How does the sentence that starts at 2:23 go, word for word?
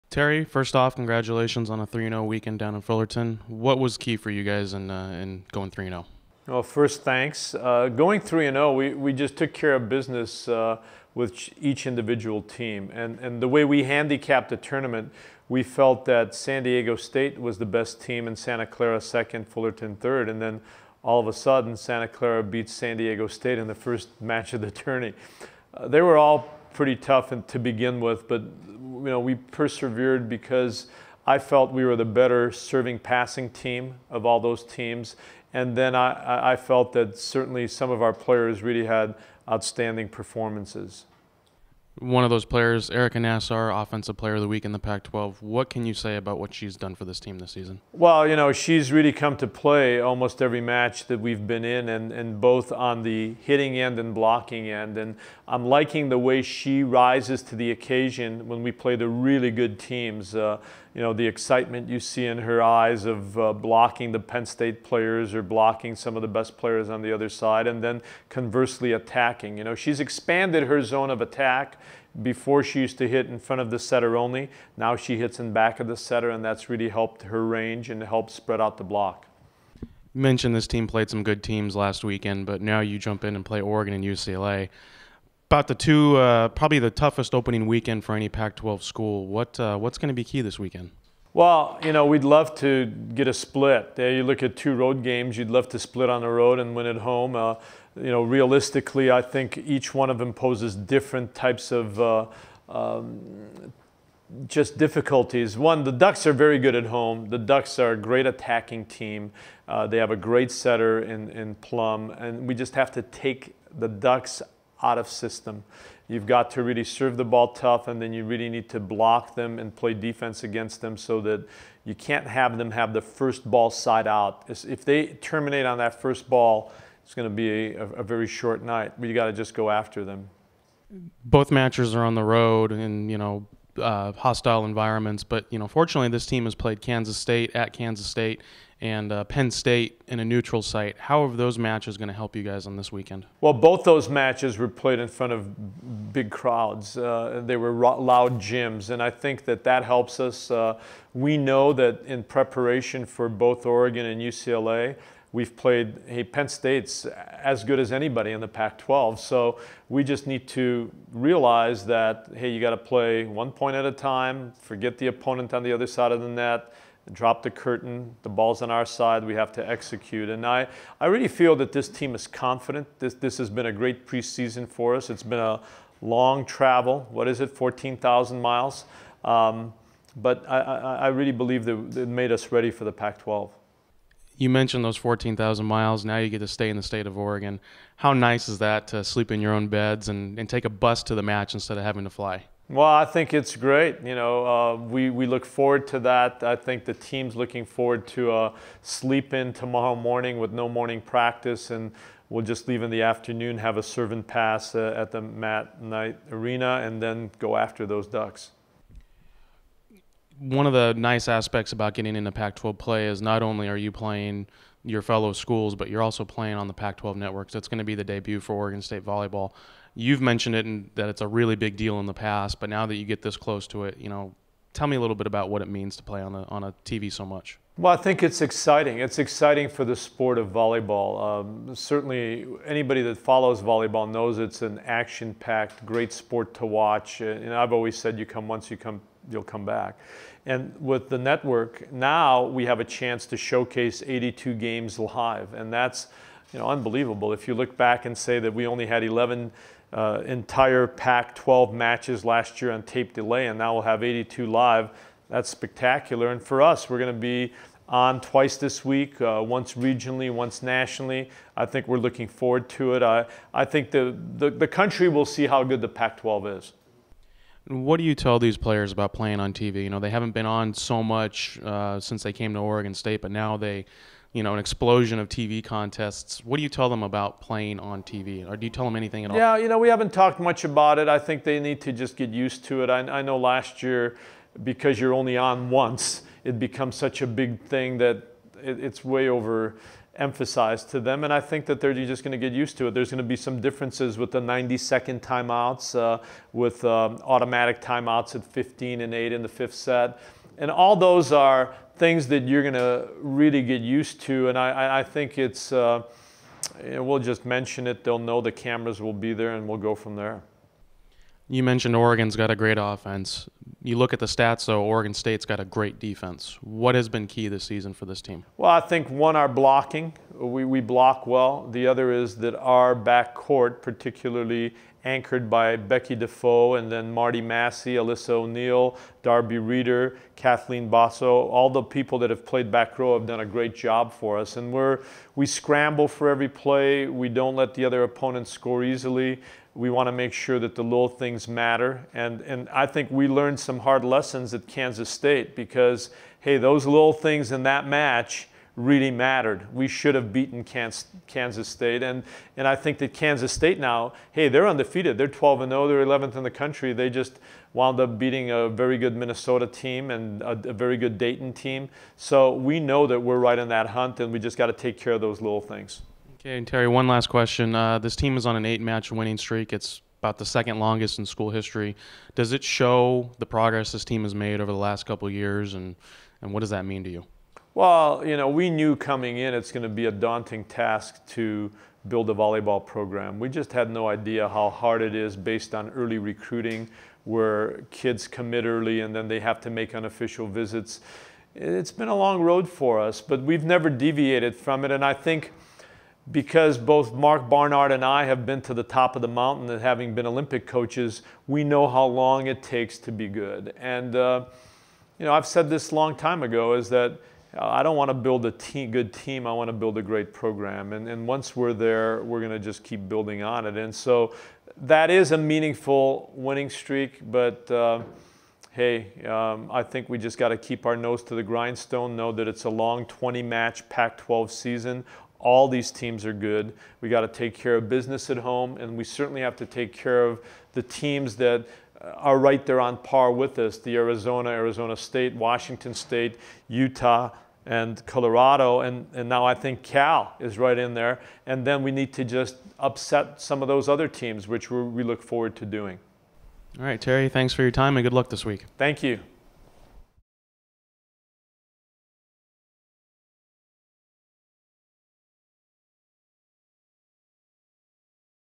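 Well, both those matches were played in front of big crowds.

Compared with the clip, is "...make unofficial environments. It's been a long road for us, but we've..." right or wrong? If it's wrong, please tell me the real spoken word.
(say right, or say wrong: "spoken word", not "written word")
wrong: "visits", not "environments".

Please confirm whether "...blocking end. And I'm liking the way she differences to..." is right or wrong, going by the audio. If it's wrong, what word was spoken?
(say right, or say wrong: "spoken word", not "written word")
wrong: "rises", not "differences".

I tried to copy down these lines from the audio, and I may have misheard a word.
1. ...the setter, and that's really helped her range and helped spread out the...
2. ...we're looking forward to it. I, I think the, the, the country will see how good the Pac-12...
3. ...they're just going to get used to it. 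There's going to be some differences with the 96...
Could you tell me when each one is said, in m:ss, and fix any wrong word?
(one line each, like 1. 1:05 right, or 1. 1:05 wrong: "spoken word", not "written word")
1. 1:15 right
2. 4:21 right
3. 4:51 wrong: "90", not "96".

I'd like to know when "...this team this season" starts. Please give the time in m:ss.
0:47.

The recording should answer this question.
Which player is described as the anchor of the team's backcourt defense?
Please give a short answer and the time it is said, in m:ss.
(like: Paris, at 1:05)
Becky Defoe, at 5:25.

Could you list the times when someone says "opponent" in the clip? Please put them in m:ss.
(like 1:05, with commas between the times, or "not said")
2:45, 5:38.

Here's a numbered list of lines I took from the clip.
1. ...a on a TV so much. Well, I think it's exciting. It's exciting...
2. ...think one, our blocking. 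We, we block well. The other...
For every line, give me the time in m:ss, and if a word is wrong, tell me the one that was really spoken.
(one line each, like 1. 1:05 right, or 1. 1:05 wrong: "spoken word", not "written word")
1. 3:46 right
2. 5:18 right.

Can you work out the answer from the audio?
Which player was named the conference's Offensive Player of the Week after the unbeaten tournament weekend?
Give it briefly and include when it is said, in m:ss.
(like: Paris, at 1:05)
Arica Nassar, at 0:42.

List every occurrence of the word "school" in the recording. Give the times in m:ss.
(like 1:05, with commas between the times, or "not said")
1:28, 3:35, 6:11.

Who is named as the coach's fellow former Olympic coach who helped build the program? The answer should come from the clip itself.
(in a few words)
Mark Barnard.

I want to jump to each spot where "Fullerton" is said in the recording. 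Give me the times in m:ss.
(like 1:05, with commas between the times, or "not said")
0:02, 0:19.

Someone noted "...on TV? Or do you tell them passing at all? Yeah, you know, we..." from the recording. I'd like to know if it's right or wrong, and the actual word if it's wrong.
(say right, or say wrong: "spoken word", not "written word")
wrong: "anything", not "passing".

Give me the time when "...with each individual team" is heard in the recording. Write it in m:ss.
0:11.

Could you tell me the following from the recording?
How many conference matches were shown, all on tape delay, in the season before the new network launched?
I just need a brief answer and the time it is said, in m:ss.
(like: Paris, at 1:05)
11, at 4:09.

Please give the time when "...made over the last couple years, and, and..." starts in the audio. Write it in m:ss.
6:14.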